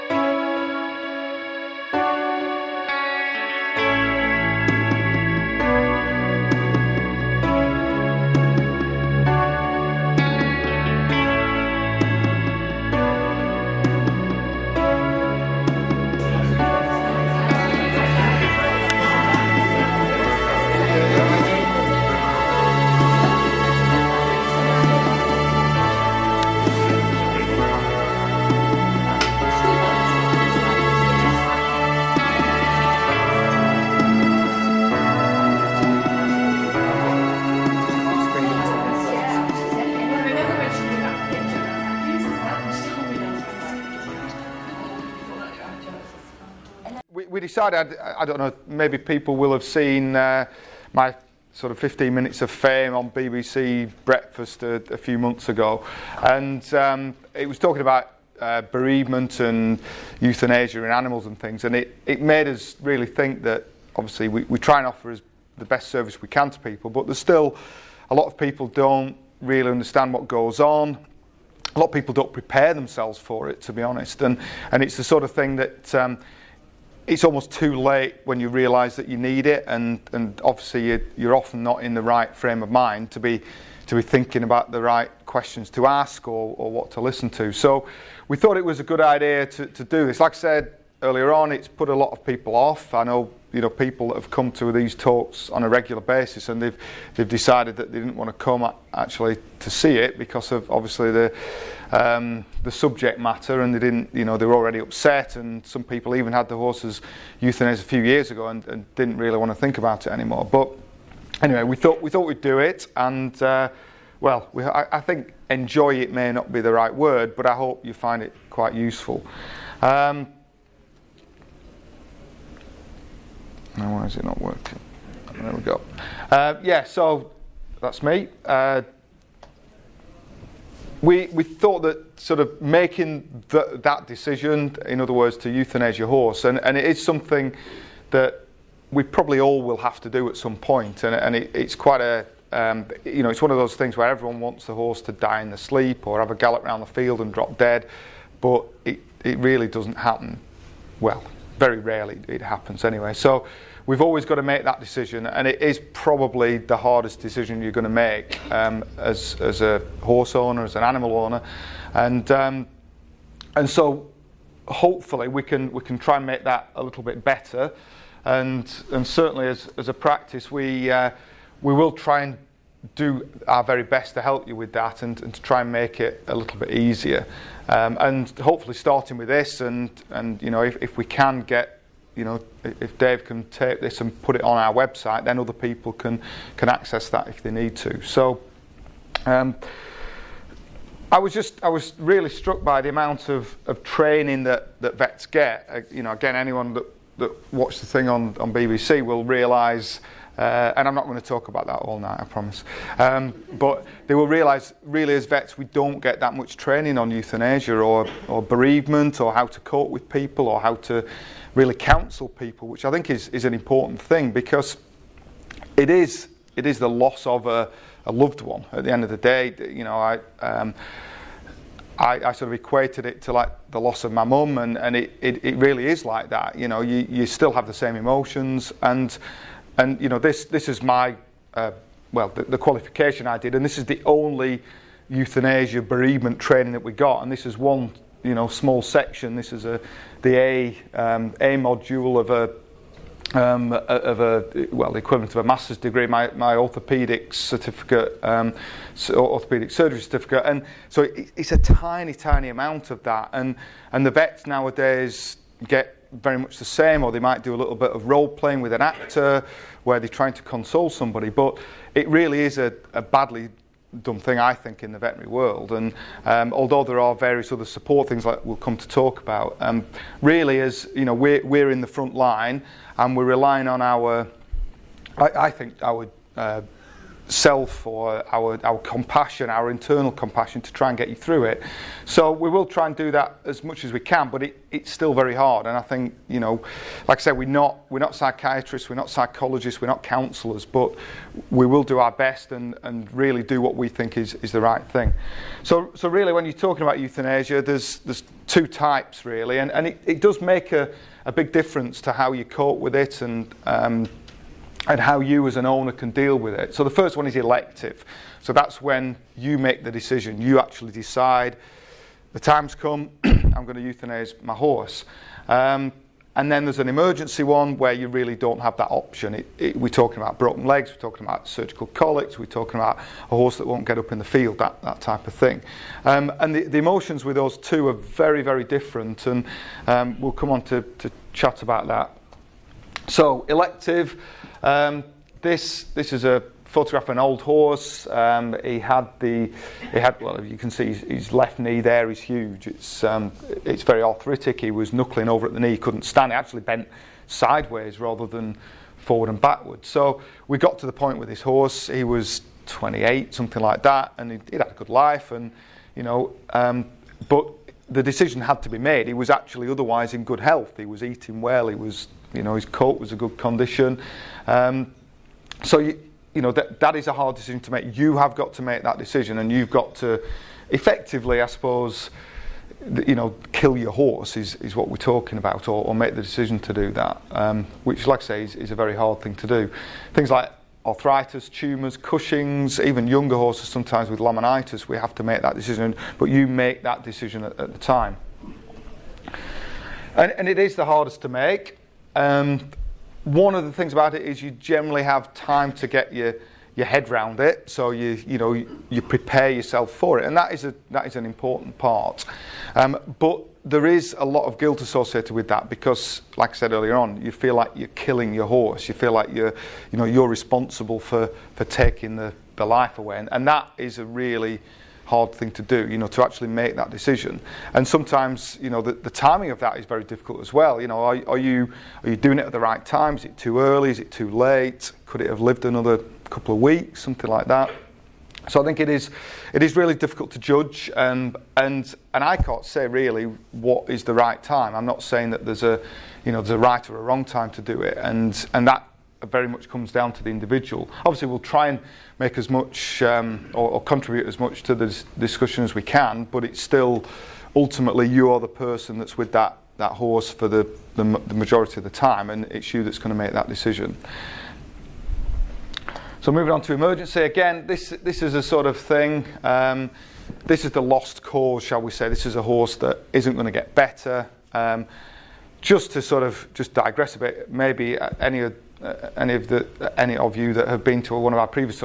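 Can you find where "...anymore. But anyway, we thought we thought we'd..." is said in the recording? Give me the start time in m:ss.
1:50.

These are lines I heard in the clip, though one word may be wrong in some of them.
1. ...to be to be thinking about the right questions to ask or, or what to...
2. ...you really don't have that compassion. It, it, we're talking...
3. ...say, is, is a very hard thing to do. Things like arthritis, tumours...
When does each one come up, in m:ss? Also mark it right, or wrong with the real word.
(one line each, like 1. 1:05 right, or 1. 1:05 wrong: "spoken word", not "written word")
1. 1:23 right
2. 5:17 wrong: "option", not "compassion"
3. 6:18 right.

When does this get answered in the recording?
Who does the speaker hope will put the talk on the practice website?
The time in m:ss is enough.
3:02.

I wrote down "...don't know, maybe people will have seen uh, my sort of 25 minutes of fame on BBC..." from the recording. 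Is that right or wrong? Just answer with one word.
wrong.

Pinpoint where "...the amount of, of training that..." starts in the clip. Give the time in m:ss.
3:12.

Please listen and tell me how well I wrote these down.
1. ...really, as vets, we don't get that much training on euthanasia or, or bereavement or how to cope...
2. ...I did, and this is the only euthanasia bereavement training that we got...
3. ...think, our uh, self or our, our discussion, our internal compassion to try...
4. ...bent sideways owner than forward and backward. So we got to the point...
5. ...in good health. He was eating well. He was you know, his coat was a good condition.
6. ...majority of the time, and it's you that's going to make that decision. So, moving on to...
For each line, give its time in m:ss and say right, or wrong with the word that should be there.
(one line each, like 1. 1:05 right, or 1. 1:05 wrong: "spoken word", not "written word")
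1. 3:24 right
2. 3:53 right
3. 4:35 wrong: "compassion", not "discussion"
4. 5:46 wrong: "rather", not "owner"
5. 6:00 right
6. 7:31 right.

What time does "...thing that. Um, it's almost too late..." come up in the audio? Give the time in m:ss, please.
1:15.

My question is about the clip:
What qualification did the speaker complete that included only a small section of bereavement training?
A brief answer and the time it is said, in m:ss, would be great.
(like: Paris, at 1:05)
orthopedic surgery certificate, at 4:09.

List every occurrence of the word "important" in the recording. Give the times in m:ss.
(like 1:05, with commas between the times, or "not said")
3:33, 6:41.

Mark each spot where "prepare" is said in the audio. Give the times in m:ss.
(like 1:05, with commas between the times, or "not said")
1:12, 6:39.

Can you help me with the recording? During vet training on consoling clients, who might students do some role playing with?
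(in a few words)
an actor.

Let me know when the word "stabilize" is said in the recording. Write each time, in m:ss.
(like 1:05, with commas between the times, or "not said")
not said.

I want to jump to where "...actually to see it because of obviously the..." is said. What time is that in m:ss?
1:38.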